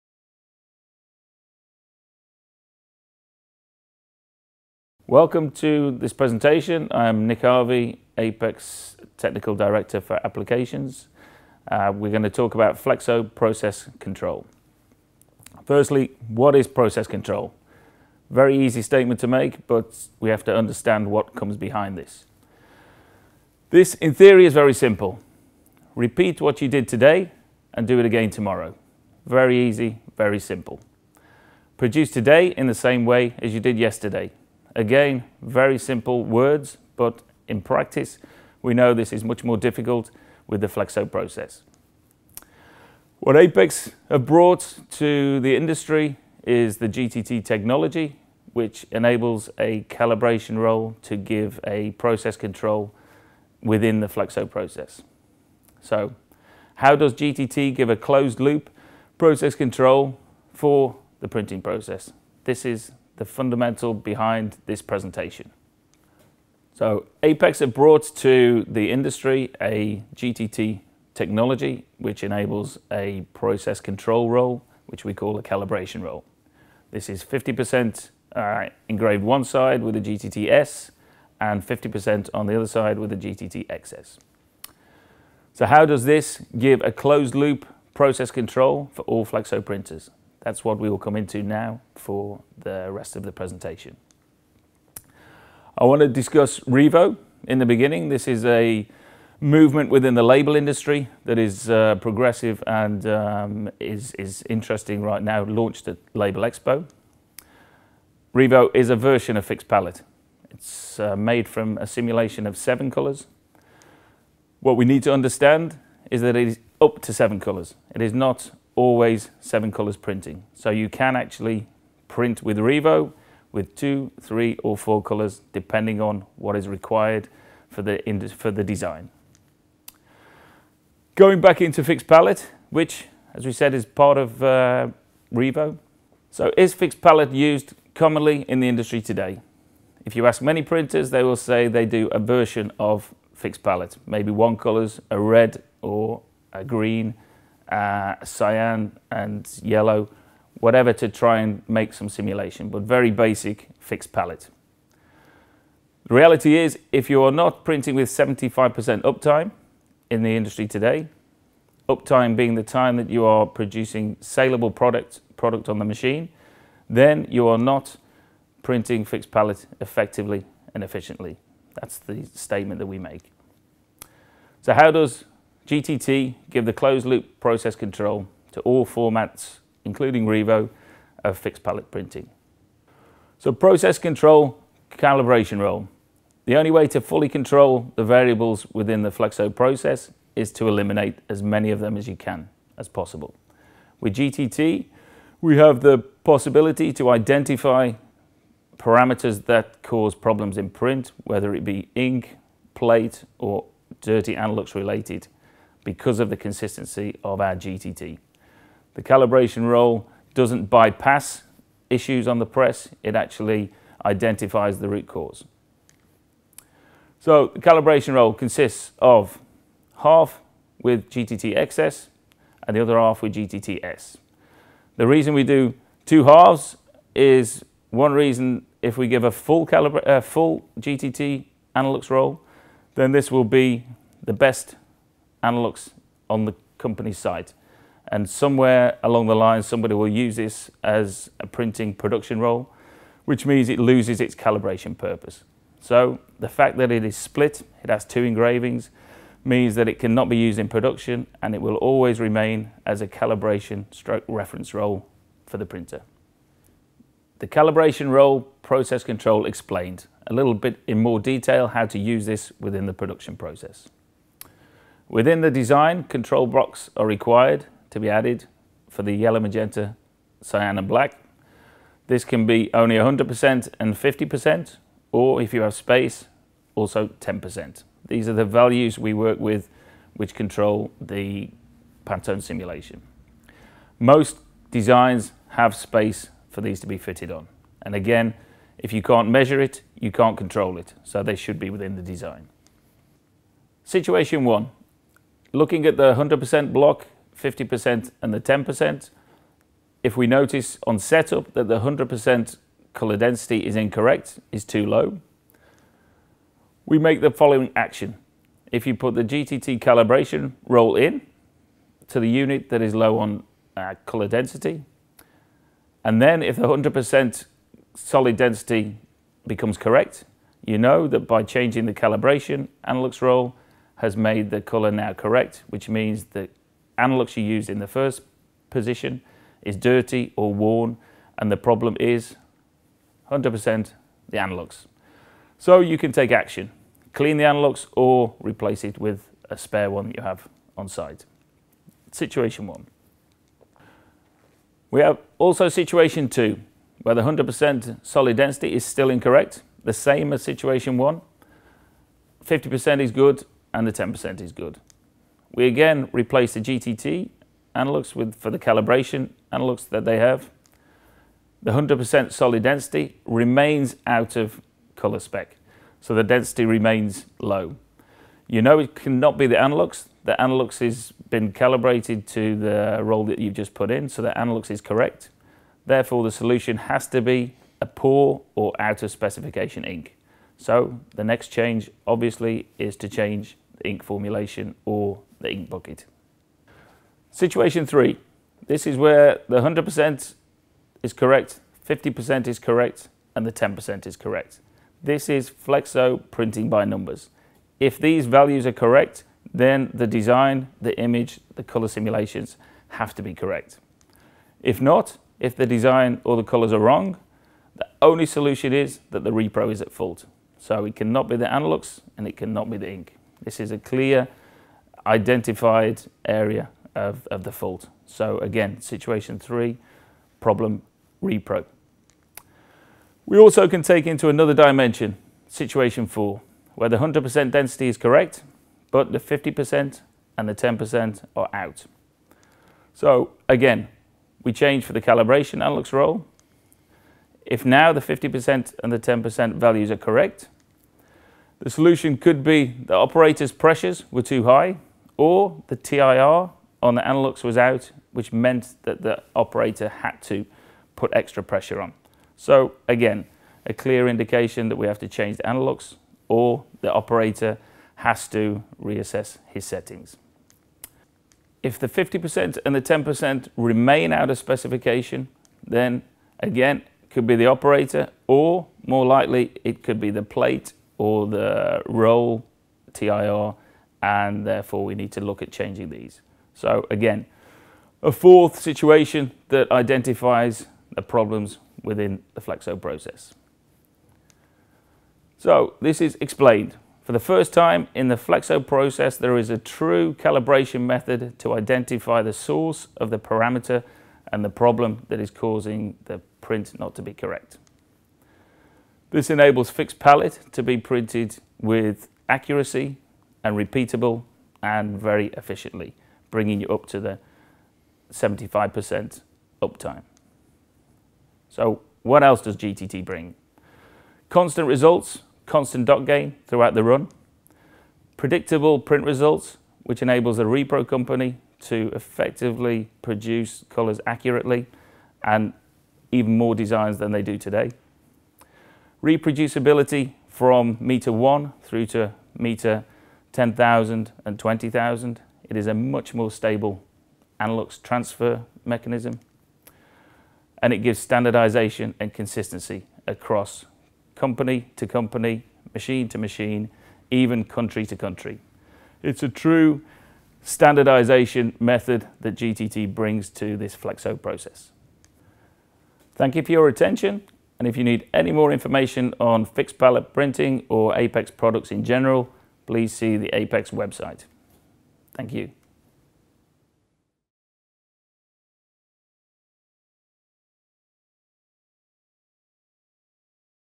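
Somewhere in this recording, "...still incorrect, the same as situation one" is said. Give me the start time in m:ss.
5:48.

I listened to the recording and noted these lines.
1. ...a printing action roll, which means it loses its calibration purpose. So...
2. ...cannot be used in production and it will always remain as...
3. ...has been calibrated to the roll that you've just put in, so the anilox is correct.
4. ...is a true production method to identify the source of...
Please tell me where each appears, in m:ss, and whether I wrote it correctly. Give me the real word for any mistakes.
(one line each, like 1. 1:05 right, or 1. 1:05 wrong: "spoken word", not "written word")
1. 4:01 wrong: "production", not "action"
2. 4:09 right
3. 6:10 right
4. 8:09 wrong: "calibration", not "production".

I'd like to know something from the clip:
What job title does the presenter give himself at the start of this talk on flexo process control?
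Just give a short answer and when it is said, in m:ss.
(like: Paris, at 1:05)
Technical Director for Applications, at 0:09.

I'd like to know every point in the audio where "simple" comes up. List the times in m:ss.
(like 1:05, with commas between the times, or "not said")
0:24, 0:30, 0:35.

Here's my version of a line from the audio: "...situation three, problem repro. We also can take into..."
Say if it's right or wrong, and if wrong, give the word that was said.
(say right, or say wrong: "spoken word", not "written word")
right.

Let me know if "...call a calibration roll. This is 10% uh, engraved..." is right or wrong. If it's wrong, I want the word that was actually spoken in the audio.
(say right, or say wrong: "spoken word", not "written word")
wrong: "50", not "10".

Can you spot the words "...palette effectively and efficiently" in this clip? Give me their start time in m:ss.
2:49.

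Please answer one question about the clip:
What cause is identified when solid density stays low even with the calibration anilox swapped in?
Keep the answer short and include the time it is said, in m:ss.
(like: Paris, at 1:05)
Poor or out of specification ink, at 6:17.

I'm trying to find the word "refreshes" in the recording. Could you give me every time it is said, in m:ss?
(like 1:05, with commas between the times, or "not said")
not said.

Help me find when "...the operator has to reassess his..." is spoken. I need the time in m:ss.
7:36.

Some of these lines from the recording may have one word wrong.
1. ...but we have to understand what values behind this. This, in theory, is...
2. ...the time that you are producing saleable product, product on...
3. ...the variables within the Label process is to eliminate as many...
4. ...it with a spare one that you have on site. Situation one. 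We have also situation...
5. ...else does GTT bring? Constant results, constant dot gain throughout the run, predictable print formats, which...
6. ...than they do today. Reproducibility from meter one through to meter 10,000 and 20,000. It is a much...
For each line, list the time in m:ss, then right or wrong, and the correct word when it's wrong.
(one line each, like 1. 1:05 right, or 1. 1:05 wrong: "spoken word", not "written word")
1. 0:19 wrong: "comes", not "values"
2. 2:42 right
3. 3:07 wrong: "Flexo", not "Label"
4. 5:38 right
5. 8:32 wrong: "results", not "formats"
6. 8:46 right.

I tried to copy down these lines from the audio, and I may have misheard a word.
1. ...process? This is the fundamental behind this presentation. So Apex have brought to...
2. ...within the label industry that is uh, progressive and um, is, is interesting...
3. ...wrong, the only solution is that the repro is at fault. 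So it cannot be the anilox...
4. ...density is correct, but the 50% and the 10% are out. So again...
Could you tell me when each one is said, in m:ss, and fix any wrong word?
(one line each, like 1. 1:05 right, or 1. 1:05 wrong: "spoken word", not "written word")
1. 1:01 right
2. 1:39 right
3. 6:46 right
4. 7:07 right.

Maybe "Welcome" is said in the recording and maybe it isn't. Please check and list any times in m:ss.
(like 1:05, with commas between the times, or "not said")
0:05.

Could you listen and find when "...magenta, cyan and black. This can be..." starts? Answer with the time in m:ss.
4:29.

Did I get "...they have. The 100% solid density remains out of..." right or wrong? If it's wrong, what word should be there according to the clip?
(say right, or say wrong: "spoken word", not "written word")
right.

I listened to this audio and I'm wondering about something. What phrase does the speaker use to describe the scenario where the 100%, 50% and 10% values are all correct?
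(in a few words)
Flexo printing by numbers.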